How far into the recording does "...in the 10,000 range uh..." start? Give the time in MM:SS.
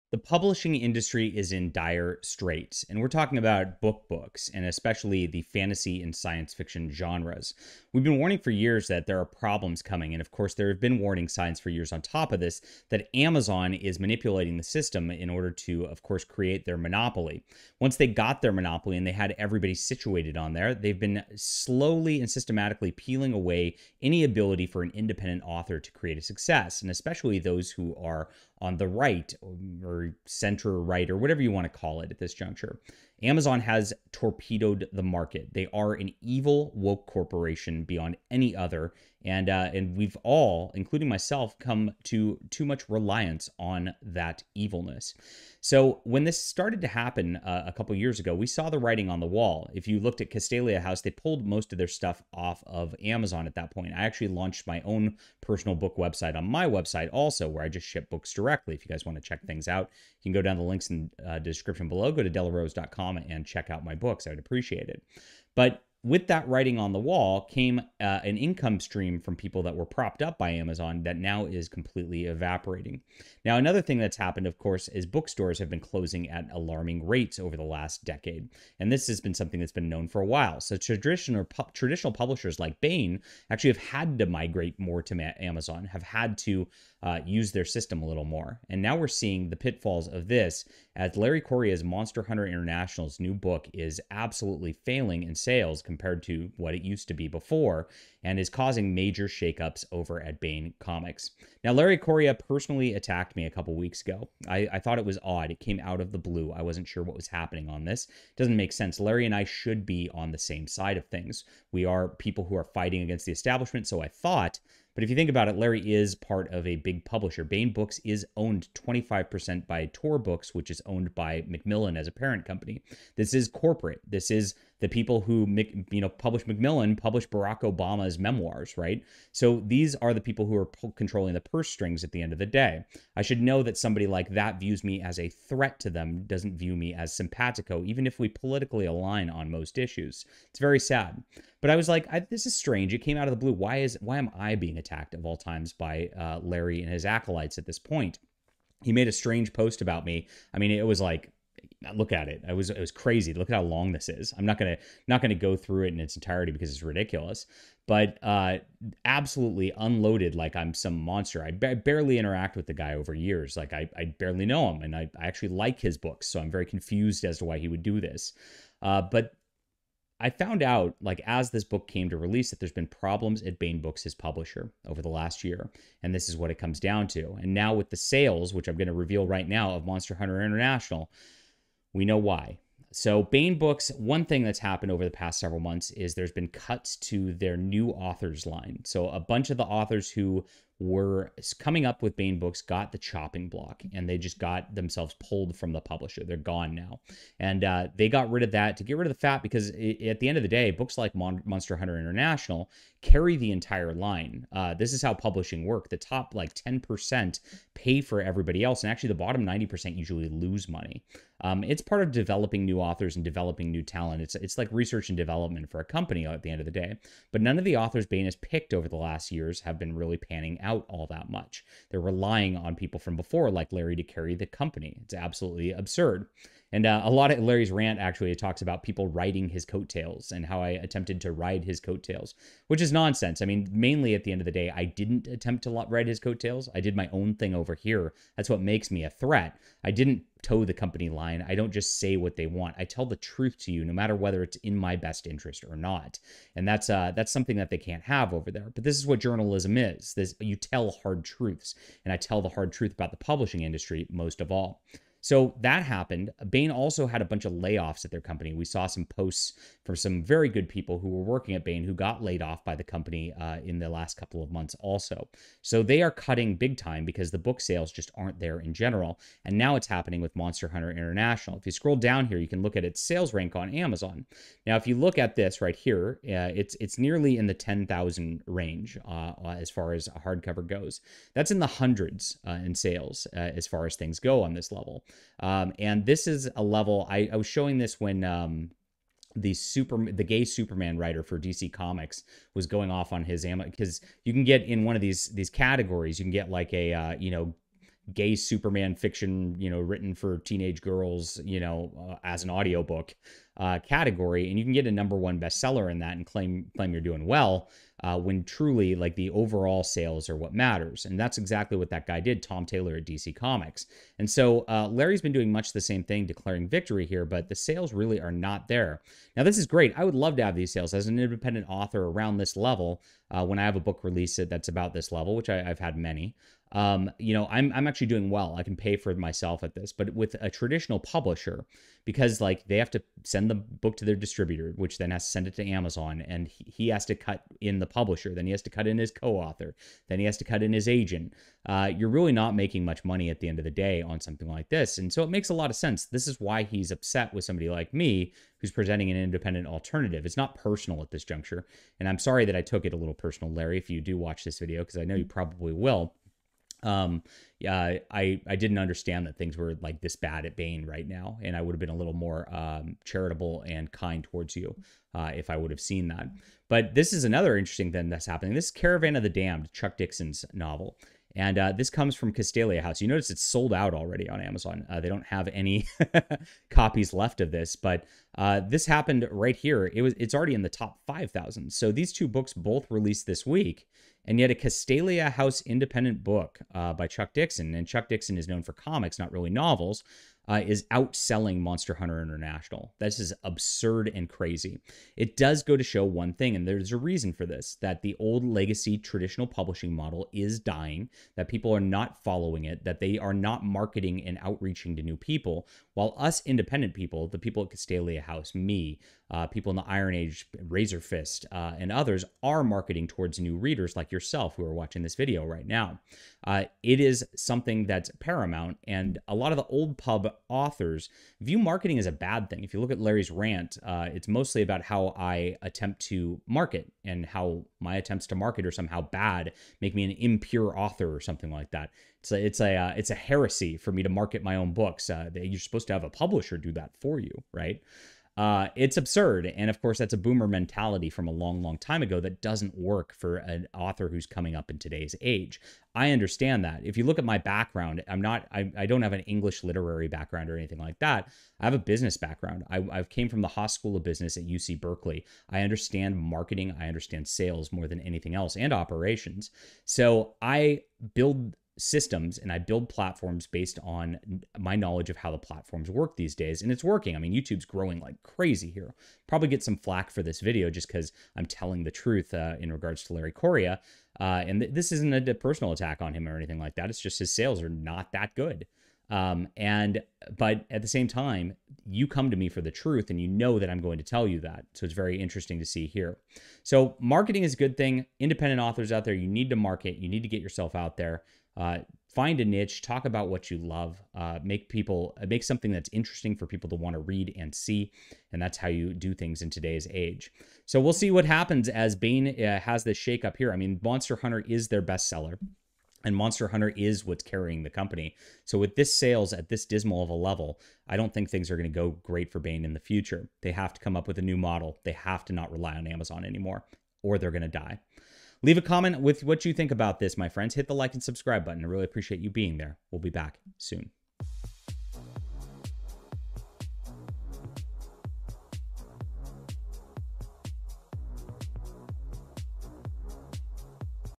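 04:37.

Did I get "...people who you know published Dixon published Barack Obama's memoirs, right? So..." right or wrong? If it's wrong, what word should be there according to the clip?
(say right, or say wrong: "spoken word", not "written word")
wrong: "Macmillan", not "Dixon".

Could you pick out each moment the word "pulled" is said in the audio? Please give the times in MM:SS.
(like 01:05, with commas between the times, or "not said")
00:51, 03:15.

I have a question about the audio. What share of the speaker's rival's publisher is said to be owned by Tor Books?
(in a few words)
25%.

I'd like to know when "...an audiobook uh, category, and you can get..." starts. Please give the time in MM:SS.
05:02.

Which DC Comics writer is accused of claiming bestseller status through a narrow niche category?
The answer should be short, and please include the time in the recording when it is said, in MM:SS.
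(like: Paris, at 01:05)
Tom Taylor, at 05:12.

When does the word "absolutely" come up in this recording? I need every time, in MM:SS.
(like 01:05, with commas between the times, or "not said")
01:34, 02:39, 03:45.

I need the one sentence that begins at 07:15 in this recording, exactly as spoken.
Uh, you're supposed to have a publisher do that for you, right?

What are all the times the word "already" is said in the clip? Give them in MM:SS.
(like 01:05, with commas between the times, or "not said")
06:13, 06:20.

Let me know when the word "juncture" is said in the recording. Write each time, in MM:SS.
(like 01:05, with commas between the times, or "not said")
00:32, 05:51.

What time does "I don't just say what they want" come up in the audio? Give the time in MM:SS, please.
04:01.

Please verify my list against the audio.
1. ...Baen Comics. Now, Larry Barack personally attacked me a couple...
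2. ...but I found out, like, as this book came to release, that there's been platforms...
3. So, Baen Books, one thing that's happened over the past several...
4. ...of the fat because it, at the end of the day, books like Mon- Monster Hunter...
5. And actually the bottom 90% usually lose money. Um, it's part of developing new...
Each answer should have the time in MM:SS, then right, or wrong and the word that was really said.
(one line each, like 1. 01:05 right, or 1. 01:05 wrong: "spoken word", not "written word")
1. 01:40 wrong: "Correa", not "Barack"
2. 02:49 wrong: "problems", not "platforms"
3. 03:02 right
4. 03:19 right
5. 03:28 right.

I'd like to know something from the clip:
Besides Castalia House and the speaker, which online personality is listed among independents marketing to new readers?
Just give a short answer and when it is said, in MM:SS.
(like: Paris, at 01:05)
Razorfist, at 06:50.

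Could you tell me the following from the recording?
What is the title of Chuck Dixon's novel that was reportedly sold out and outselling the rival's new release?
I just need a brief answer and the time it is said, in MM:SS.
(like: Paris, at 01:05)
Caravan of the Damned, at 06:08.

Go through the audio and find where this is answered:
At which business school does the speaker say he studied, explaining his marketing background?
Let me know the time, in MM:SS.
07:33.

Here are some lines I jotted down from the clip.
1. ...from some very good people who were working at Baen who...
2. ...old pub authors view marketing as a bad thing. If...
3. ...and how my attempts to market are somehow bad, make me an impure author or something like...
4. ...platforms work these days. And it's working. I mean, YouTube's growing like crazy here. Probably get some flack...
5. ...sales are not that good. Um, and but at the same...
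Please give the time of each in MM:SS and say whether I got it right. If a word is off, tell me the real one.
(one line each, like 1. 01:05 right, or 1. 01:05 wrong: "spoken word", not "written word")
1. 04:19 right
2. 06:59 right
3. 07:07 right
4. 07:45 right
5. 07:57 right.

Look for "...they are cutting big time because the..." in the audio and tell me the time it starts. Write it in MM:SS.
04:25.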